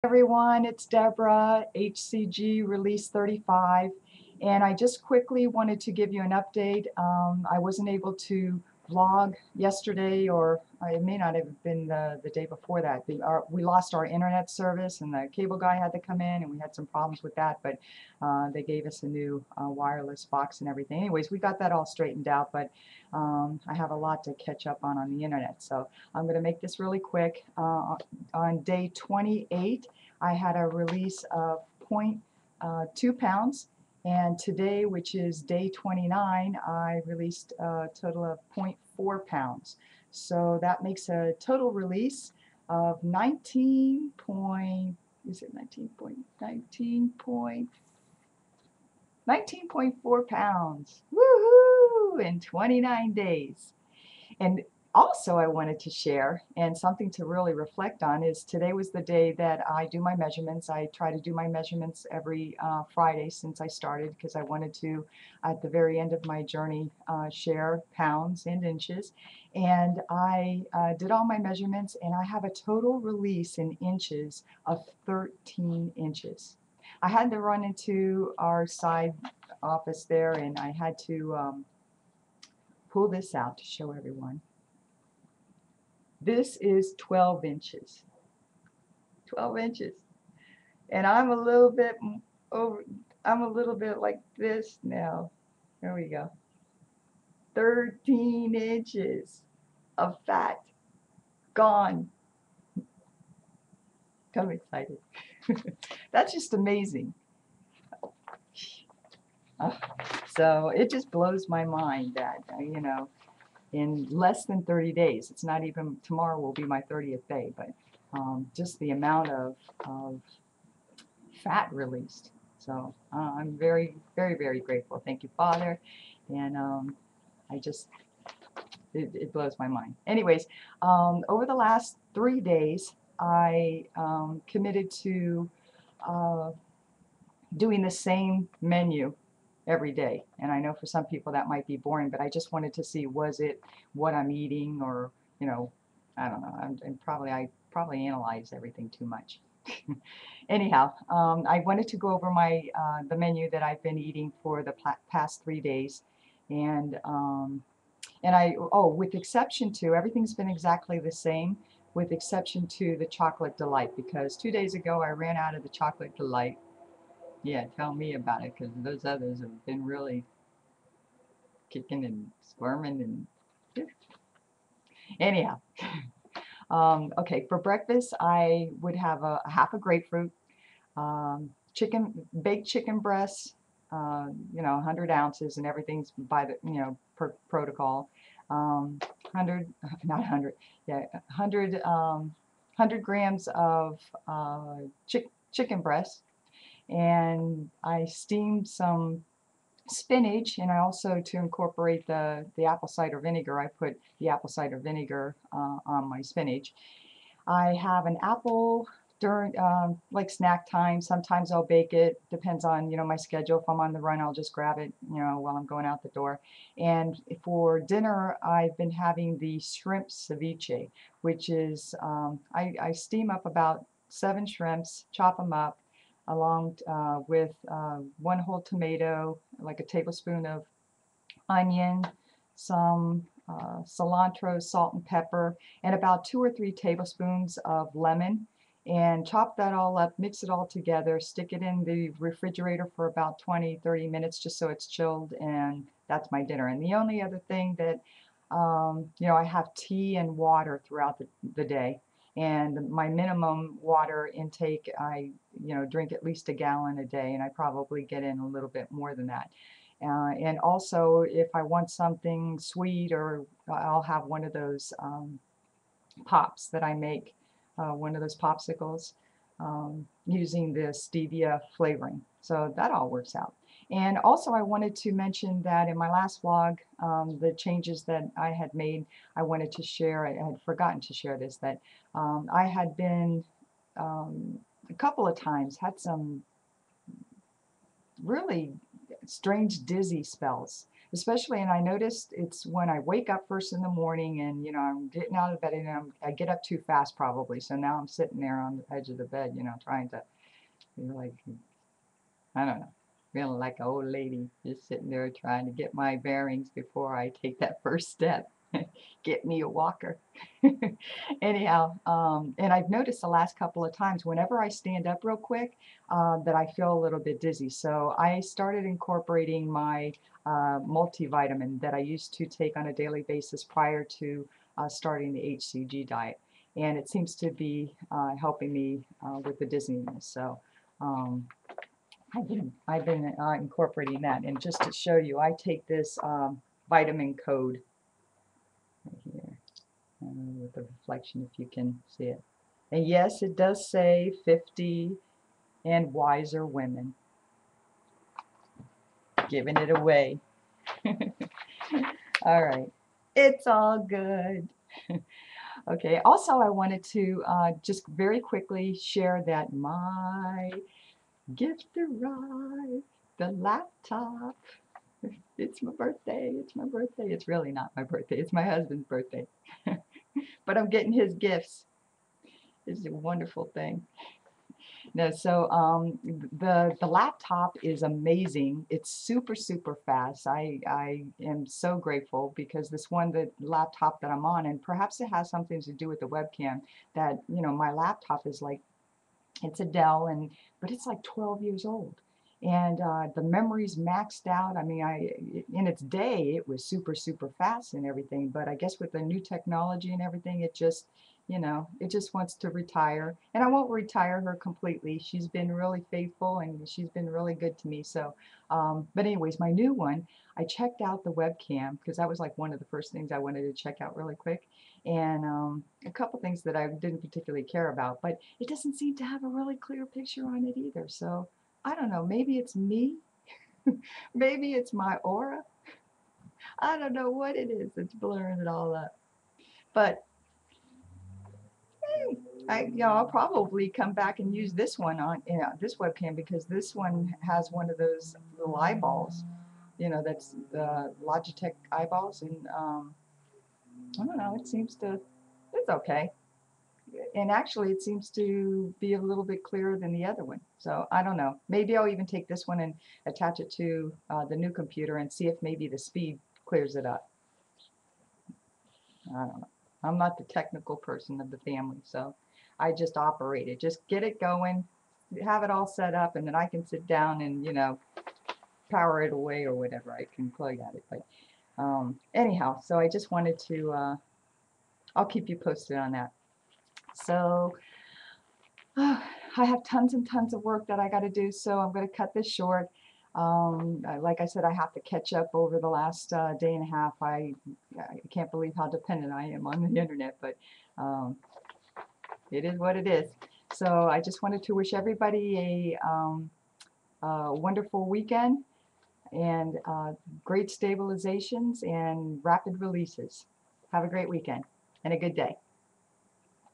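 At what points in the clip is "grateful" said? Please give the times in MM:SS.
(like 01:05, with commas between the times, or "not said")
02:04, 06:21.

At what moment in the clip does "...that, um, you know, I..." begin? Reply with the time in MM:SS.
04:07.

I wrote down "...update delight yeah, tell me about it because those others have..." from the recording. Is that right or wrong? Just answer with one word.
wrong.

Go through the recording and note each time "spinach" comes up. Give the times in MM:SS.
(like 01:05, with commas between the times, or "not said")
03:19, 03:26.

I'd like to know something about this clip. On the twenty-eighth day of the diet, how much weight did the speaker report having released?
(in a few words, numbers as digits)
0.2 pounds.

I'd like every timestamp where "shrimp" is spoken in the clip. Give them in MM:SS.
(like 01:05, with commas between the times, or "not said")
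03:39, 03:44.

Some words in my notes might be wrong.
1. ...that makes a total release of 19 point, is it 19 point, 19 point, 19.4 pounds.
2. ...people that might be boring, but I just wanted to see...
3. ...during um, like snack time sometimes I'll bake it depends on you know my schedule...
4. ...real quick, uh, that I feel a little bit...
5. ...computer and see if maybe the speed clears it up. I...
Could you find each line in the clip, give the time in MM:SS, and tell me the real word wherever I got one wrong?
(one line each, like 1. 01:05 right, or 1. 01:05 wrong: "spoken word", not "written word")
1. 00:40 right
2. 02:21 right
3. 03:29 right
4. 05:15 right
5. 07:34 right.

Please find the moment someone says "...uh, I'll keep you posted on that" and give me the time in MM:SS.
07:53.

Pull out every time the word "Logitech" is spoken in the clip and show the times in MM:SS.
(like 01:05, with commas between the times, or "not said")
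07:21.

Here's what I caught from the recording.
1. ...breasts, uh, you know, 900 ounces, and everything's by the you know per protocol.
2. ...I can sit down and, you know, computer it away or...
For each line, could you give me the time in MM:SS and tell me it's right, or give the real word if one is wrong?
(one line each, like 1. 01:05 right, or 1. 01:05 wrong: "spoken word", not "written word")
1. 03:02 wrong: "100", not "900"
2. 07:46 wrong: "power", not "computer".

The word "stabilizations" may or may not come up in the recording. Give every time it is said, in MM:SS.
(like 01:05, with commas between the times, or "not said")
08:20.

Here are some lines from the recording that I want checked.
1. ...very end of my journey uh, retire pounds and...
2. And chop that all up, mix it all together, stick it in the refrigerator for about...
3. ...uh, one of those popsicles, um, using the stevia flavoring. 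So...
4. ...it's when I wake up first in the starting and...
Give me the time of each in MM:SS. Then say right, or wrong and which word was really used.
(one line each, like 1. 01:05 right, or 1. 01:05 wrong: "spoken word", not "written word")
1. 01:05 wrong: "share", not "retire"
2. 03:58 right
3. 04:27 right
4. 04:52 wrong: "morning", not "starting".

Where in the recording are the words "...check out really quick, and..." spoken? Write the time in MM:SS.
06:53.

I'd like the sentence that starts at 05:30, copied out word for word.
So um, I've been, I've been uh, incorporating that.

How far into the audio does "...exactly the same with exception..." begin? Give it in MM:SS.
02:40.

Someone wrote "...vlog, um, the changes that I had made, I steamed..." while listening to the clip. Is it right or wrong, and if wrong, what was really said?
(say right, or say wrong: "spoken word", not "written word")
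wrong: "wanted", not "steamed".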